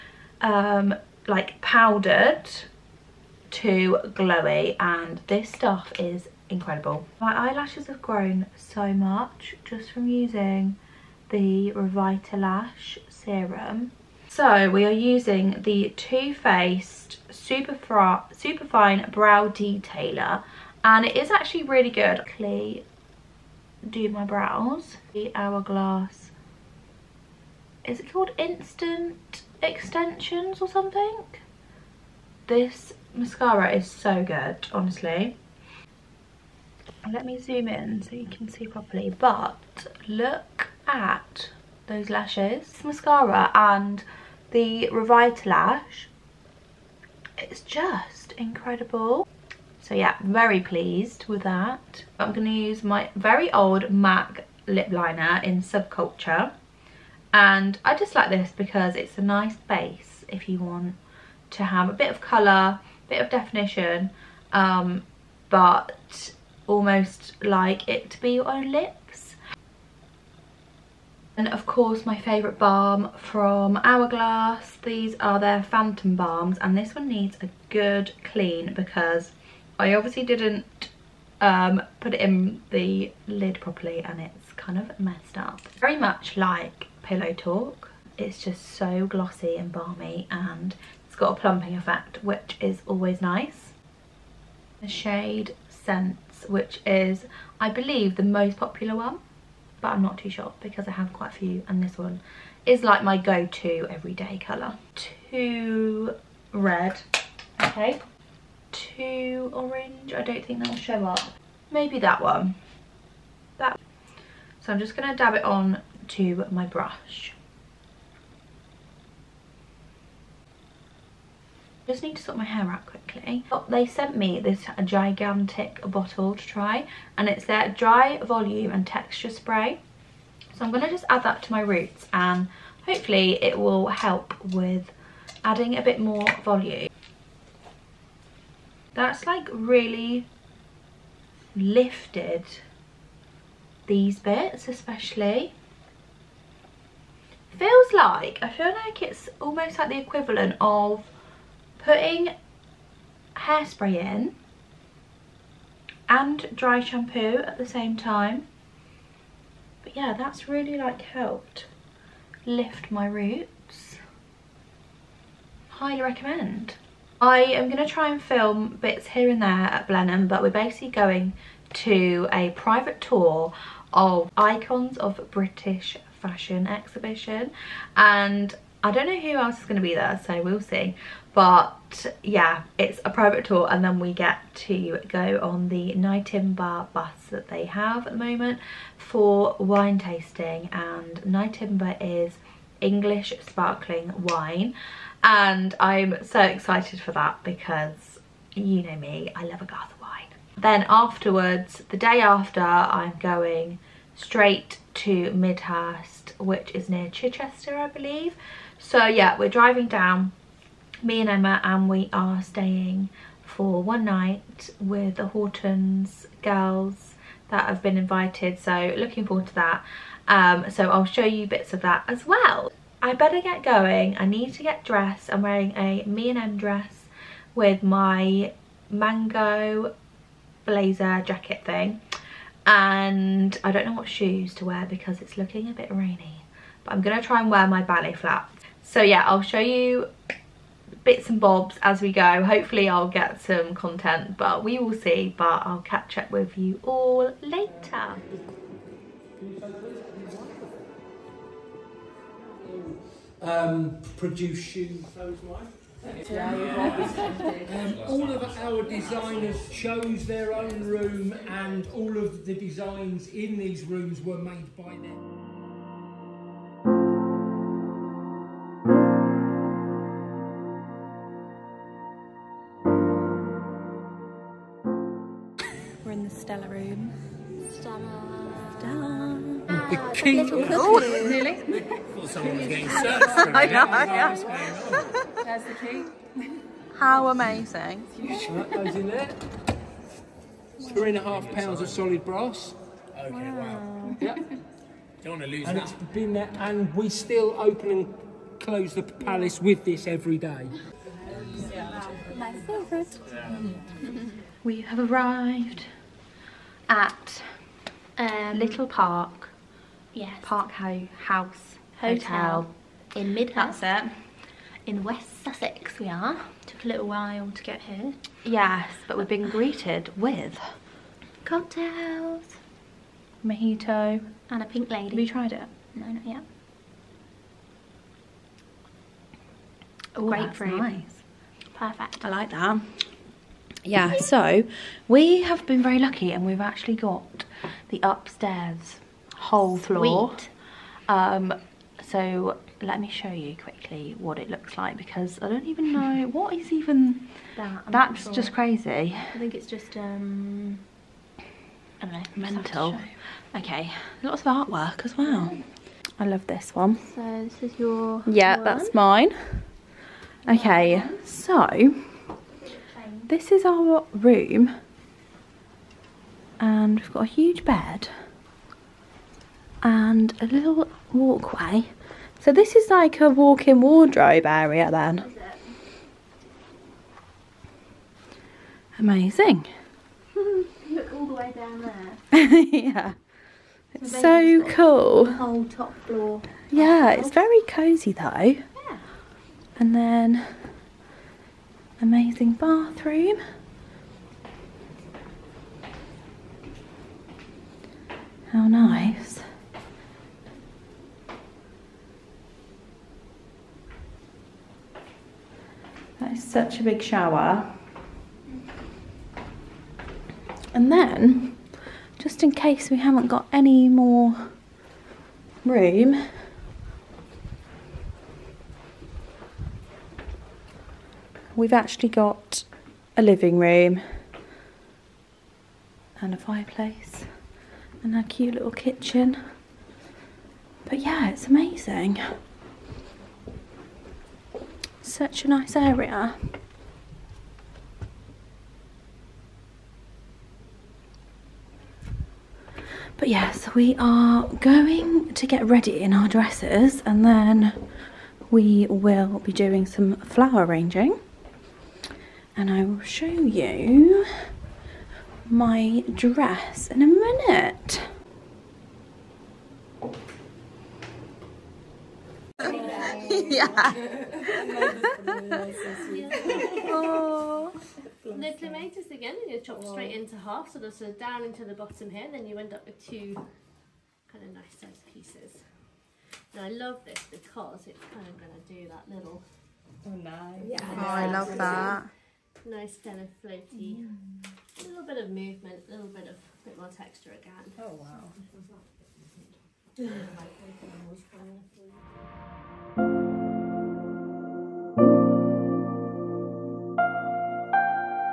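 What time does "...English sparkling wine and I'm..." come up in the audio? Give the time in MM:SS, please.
03:12.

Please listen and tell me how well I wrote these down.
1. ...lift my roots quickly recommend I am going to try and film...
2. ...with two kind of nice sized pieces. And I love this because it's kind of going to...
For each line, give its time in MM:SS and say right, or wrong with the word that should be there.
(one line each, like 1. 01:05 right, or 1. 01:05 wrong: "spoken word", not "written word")
1. 02:42 wrong: "highly", not "quickly"
2. 07:52 right.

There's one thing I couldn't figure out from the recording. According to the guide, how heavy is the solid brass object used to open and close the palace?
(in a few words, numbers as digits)
3.5 pounds.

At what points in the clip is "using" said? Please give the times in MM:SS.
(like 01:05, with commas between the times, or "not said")
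00:10, 00:14.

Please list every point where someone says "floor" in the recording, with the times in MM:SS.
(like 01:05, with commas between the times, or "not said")
05:39, 06:26.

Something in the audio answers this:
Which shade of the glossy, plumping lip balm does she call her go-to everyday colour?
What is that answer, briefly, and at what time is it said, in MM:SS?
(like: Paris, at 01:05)
Scents, at 01:35.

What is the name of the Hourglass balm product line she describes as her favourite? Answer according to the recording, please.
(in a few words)
Phantom Balms.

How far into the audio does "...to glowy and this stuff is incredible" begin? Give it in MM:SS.
00:03.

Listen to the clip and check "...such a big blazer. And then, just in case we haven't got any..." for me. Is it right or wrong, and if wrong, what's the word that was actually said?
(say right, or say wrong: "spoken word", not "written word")
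wrong: "shower", not "blazer".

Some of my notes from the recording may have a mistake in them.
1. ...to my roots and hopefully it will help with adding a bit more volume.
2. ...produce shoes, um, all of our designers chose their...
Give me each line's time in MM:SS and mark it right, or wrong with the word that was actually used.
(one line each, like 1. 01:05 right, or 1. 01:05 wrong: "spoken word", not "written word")
1. 02:11 right
2. 04:14 right.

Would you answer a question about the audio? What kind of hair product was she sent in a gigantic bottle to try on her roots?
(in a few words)
dry volume and texture spray.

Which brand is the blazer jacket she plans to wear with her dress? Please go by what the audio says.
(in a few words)
Mango.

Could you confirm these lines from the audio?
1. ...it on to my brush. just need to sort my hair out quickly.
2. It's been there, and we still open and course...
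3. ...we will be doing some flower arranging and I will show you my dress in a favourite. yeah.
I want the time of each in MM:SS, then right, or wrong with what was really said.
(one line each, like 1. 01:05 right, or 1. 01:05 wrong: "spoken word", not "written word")
1. 01:55 right
2. 04:55 wrong: "close", not "course"
3. 07:28 wrong: "minute", not "favourite".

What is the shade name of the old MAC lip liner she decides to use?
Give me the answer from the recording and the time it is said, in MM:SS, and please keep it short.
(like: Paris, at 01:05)
Subculture, at 00:55.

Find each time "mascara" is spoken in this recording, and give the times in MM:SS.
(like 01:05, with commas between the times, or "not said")
00:33, 00:42.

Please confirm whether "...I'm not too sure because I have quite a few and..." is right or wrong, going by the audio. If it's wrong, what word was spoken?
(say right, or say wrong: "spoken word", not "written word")
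right.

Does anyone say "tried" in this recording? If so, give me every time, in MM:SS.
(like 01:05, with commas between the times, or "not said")
05:25.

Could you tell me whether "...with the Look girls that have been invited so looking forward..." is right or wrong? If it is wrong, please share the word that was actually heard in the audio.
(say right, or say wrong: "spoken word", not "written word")
wrong: "Hortons", not "Look".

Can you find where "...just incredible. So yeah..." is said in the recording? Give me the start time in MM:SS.
00:47.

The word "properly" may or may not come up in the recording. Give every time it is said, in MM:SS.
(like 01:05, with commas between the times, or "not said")
00:38, 01:23.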